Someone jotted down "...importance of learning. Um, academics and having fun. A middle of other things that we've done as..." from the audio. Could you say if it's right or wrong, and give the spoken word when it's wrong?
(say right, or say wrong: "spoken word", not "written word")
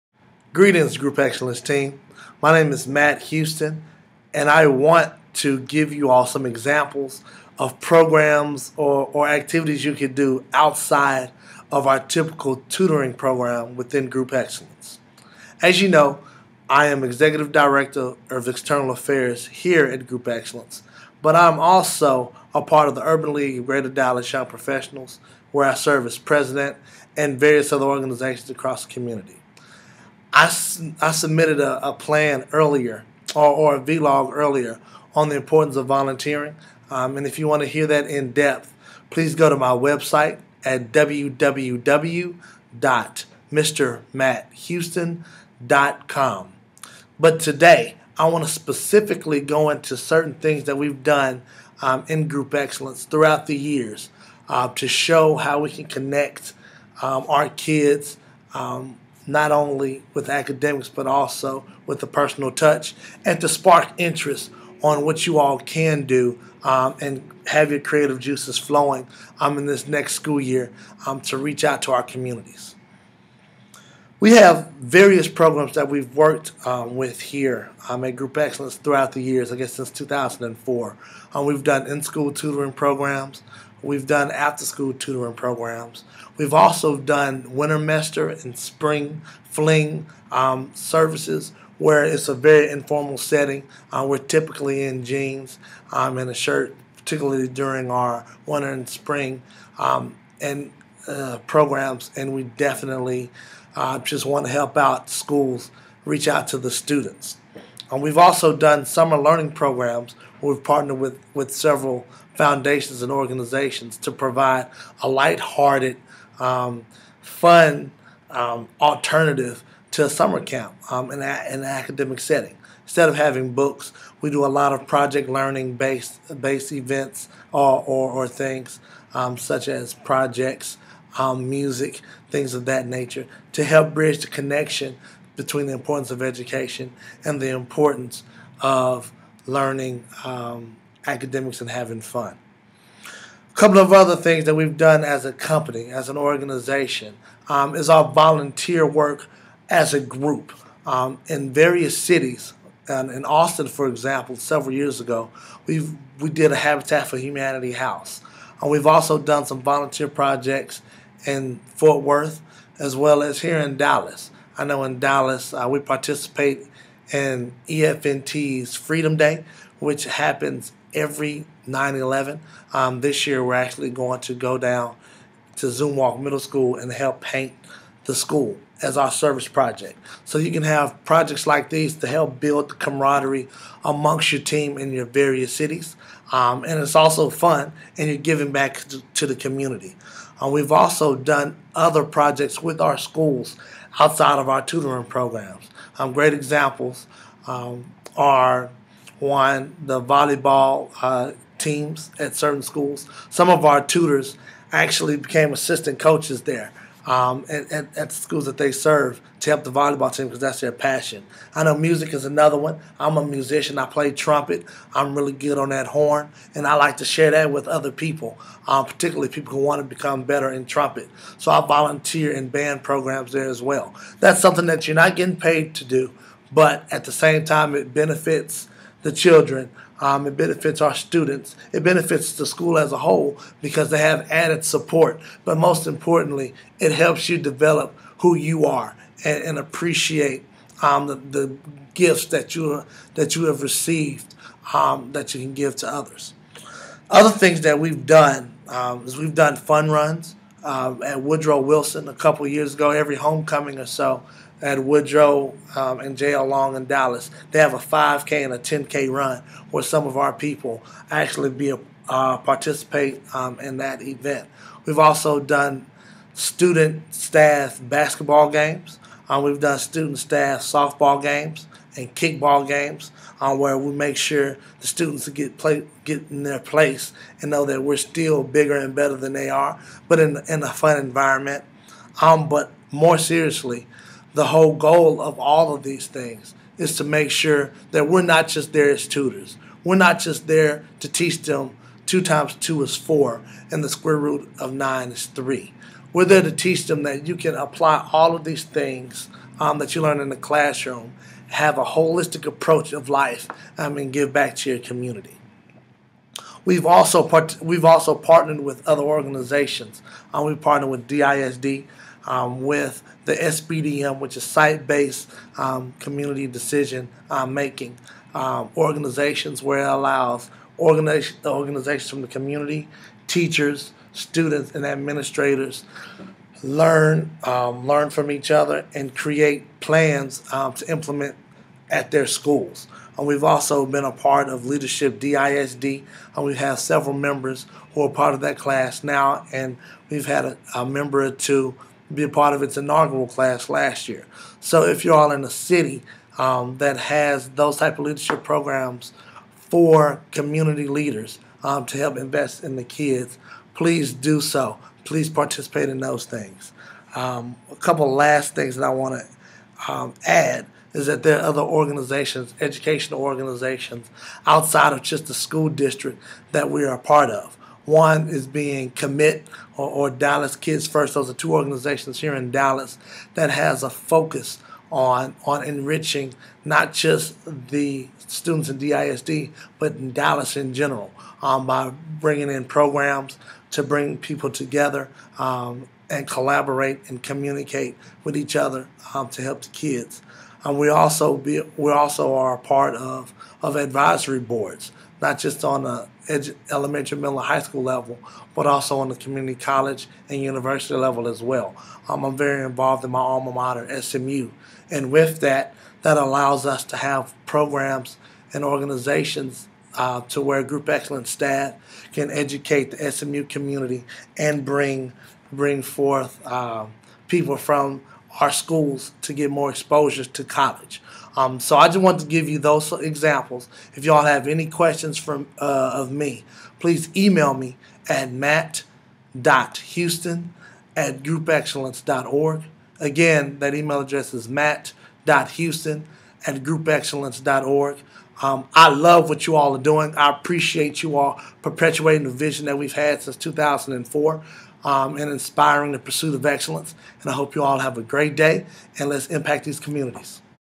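wrong: "couple", not "middle".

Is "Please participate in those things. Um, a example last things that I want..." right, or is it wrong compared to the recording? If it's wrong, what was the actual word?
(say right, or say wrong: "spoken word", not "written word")
wrong: "couple", not "example".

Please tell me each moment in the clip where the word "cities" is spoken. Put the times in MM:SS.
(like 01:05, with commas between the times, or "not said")
02:31, 03:05.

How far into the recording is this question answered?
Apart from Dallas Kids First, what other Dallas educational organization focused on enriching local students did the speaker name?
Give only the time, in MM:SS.
06:08.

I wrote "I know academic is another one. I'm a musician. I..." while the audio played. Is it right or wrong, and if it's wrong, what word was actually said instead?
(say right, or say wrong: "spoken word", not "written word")
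wrong: "music", not "academic".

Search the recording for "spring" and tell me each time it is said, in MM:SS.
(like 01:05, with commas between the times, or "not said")
01:28, 01:38.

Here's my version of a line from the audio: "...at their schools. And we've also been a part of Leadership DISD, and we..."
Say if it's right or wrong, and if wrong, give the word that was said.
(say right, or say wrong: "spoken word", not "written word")
right.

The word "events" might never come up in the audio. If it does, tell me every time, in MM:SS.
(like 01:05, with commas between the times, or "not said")
02:06, 04:24.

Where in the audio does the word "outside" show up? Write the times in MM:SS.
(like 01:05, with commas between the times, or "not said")
00:10, 03:13, 06:04.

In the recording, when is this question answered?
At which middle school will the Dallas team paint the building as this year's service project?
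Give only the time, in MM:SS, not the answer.
02:55.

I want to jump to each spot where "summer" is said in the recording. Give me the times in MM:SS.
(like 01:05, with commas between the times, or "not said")
01:48, 02:00.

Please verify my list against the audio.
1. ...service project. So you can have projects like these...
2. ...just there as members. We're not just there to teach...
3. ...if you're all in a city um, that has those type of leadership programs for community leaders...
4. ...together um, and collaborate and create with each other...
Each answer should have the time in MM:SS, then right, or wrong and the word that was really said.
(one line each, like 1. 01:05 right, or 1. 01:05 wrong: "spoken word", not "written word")
1. 02:59 right
2. 04:48 wrong: "tutors", not "members"
3. 05:44 right
4. 06:24 wrong: "communicate", not "create".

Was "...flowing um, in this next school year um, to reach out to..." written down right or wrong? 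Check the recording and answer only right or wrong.
right.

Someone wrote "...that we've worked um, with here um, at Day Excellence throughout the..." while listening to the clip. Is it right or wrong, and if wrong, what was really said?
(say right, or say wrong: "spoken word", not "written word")
wrong: "Group", not "Day".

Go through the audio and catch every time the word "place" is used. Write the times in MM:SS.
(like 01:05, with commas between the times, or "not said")
04:36.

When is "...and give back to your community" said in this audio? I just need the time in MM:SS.
05:03.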